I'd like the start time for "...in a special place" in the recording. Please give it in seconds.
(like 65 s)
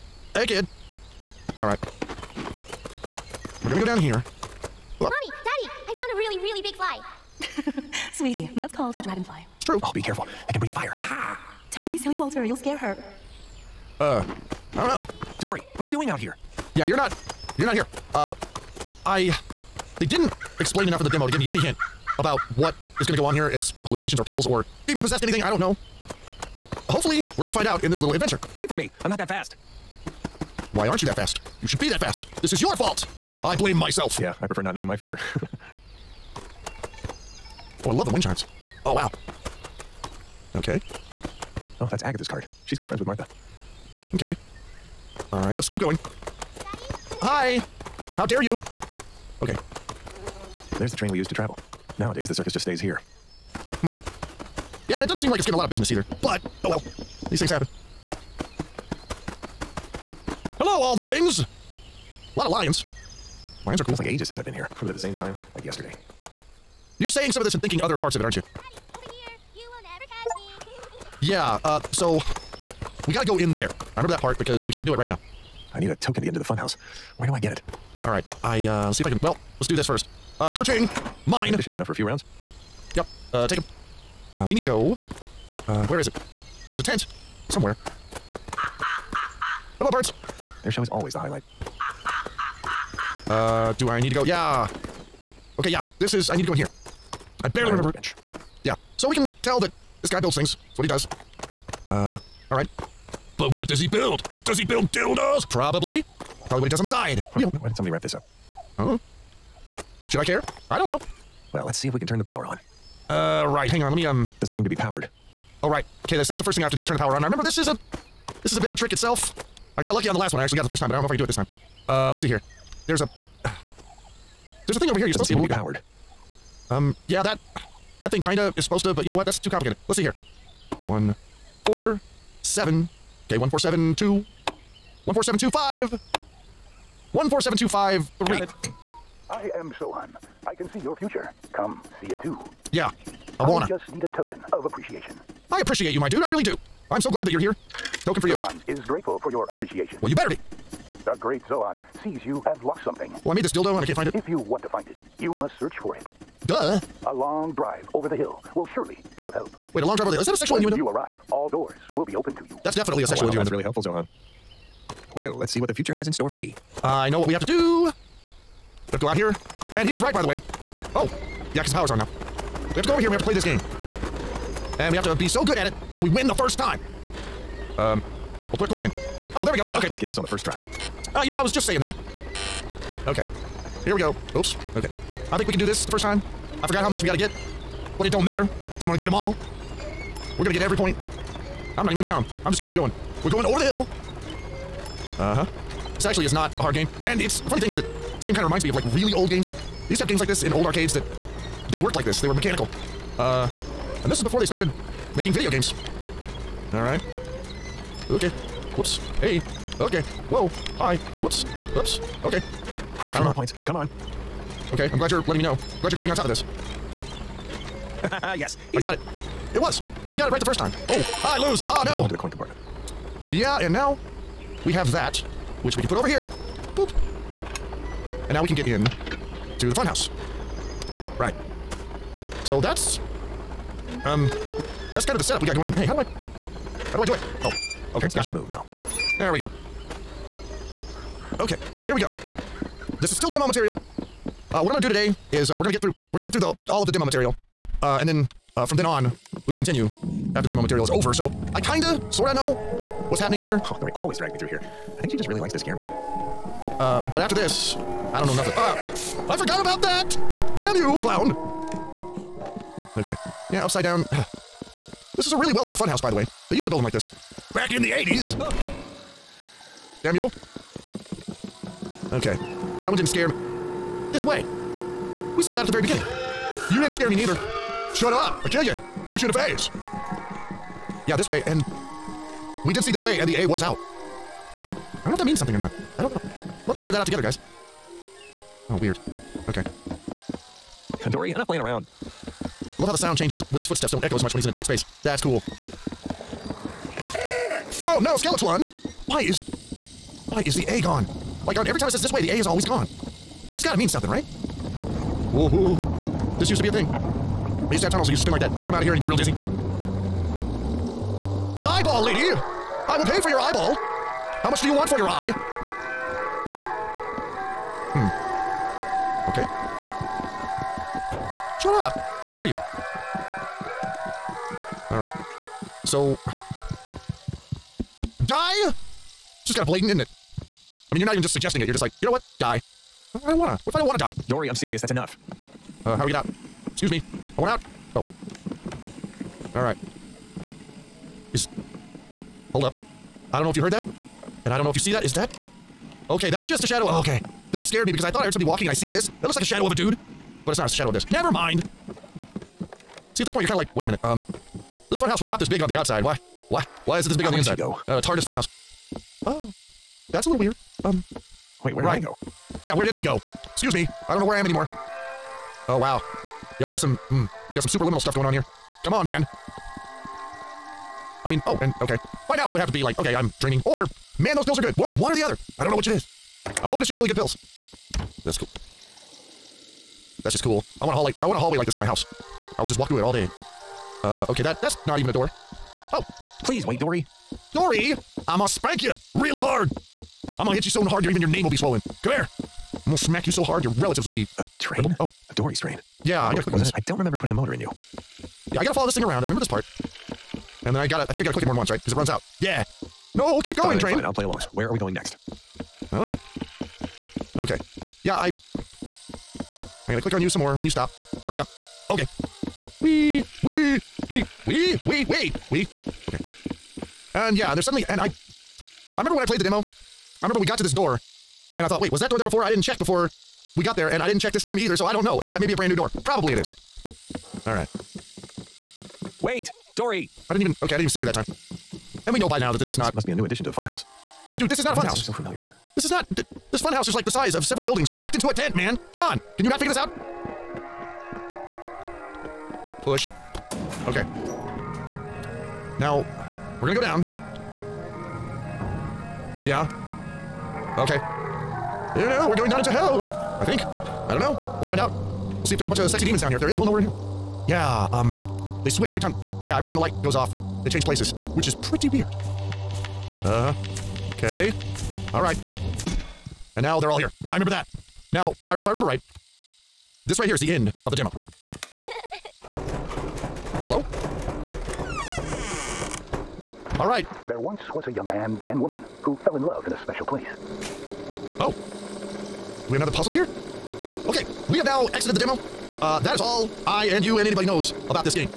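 479 s.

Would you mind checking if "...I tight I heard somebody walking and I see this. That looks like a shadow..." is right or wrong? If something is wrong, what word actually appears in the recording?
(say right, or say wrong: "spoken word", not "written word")
wrong: "thought", not "tight".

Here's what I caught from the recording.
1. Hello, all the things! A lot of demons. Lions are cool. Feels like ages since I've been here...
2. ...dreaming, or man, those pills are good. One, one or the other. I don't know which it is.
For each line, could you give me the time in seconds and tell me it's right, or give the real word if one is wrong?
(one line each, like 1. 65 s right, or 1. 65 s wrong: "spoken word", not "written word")
1. 60 s wrong: "lions", not "demons"
2. 373 s right.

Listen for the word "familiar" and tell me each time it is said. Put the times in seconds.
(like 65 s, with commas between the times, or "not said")
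435 s.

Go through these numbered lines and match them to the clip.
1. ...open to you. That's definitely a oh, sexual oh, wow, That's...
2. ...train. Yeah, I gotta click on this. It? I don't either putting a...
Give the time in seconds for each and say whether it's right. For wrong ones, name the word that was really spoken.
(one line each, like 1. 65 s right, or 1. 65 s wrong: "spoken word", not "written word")
1. 162 s right
2. 395 s wrong: "remember", not "either".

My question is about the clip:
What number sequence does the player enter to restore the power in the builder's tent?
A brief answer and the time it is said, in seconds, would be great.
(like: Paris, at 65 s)
147253, at 137 s.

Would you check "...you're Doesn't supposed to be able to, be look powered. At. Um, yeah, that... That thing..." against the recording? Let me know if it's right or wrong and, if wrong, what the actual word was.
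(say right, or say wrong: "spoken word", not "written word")
right.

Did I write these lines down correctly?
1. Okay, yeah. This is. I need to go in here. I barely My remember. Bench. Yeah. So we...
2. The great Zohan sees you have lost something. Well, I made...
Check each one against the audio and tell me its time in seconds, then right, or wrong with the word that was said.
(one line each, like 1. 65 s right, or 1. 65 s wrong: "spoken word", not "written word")
1. 95 s right
2. 151 s right.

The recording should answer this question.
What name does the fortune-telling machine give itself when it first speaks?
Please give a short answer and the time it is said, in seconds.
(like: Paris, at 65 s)
Sohan, at 139 s.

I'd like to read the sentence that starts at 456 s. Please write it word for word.
If there is, we'll know we're in hell.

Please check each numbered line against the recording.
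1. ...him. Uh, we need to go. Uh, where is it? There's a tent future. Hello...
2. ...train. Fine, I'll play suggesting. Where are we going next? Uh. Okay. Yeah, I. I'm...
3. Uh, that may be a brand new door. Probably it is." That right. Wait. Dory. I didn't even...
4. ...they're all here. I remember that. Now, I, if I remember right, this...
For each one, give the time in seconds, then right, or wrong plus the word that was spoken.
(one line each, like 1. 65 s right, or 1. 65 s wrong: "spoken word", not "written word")
1. 83 s wrong: "somewhere", not "future"
2. 403 s wrong: "along", not "suggesting"
3. 425 s wrong: "All", not "That"
4. 466 s right.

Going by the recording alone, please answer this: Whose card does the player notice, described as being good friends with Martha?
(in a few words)
Agatha.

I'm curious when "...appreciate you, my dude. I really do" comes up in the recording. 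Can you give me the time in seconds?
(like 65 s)
145 s.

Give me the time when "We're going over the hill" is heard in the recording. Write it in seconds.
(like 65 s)
193 s.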